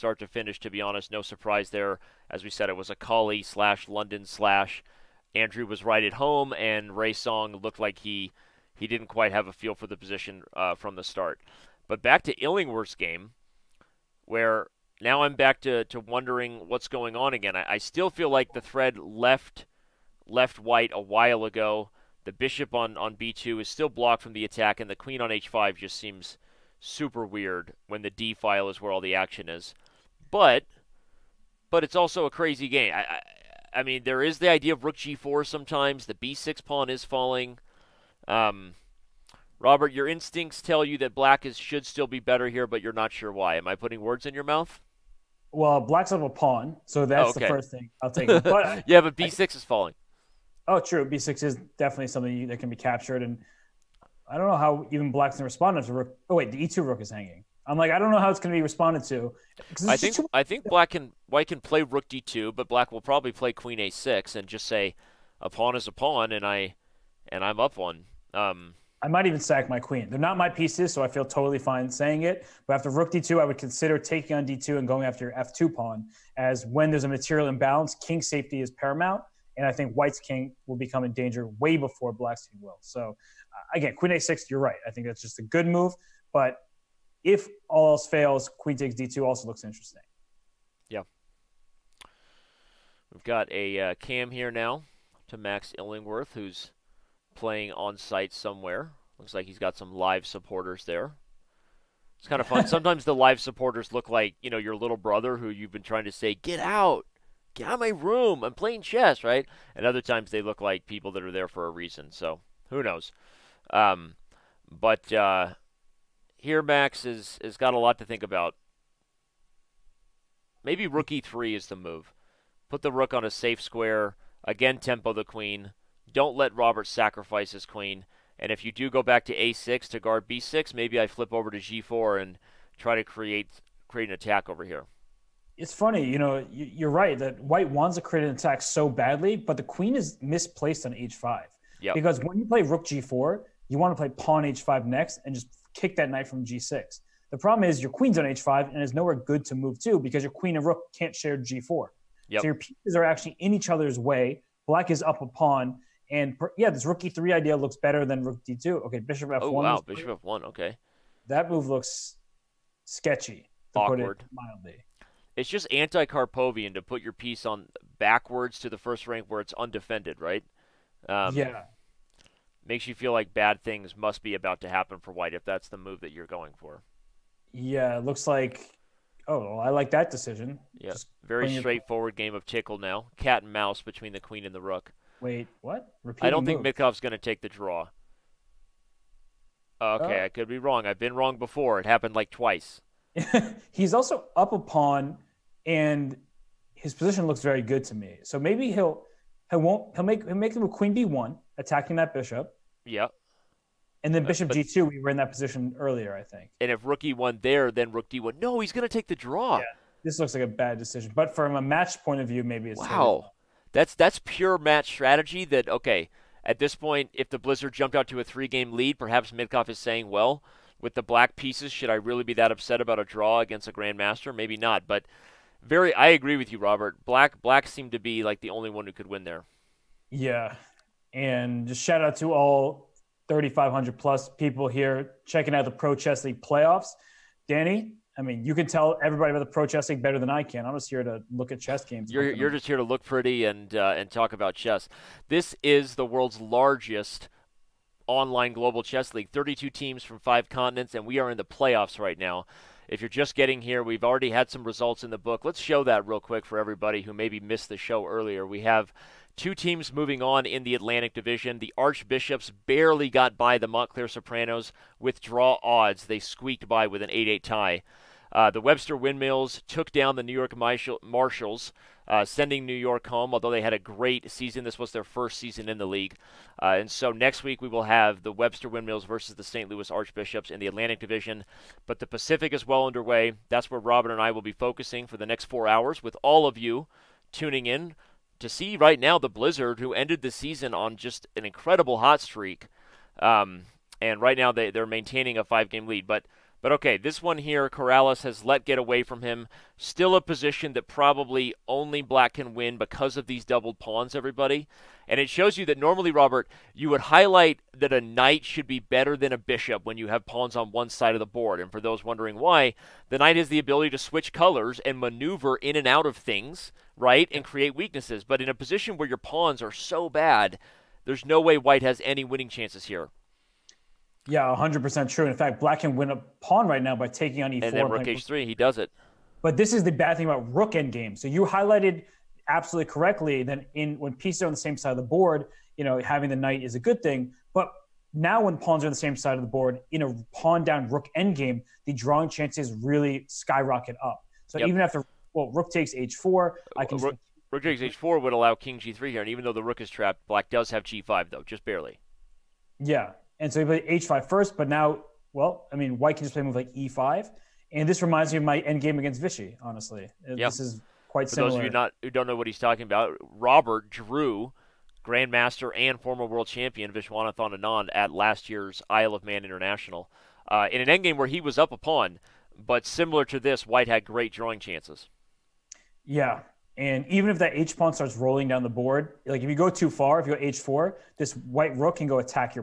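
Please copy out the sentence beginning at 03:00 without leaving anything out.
Yeah, just very straightforward game of tickle now.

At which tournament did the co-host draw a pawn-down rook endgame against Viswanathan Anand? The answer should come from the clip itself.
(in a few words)
Isle of Man International.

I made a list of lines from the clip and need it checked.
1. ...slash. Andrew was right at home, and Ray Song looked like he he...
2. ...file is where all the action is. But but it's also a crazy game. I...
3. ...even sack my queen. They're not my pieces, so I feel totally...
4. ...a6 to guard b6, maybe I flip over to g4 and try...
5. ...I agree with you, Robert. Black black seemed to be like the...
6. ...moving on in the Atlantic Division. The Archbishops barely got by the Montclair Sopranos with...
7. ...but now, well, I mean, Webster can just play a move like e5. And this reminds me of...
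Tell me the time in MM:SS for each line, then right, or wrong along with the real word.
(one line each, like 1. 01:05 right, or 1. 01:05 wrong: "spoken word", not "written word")
1. 00:04 right
2. 00:28 right
3. 01:09 right
4. 02:09 right
5. 03:45 right
6. 04:19 right
7. 05:54 wrong: "White", not "Webster".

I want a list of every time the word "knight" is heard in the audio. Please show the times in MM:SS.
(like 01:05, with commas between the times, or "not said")
02:26, 05:08, 05:13, 05:36.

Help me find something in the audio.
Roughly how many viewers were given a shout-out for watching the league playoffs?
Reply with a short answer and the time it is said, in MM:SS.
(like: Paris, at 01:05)
3,500, at 03:53.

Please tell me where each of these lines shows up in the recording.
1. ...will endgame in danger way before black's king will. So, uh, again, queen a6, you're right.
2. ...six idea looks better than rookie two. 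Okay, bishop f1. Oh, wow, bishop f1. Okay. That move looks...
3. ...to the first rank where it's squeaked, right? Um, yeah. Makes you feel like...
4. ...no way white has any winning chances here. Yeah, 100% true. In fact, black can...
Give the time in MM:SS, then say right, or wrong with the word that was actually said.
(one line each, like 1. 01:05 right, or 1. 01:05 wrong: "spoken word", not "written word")
1. 01:20 wrong: "become", not "endgame"
2. 02:37 wrong: "three", not "six"
3. 02:48 wrong: "undefended", not "squeaked"
4. 05:21 right.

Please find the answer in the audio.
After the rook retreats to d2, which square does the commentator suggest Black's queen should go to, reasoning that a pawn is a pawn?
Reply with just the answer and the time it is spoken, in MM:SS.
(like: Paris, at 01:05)
a6, at 01:03.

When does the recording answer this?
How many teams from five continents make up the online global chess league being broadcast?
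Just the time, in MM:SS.
04:09.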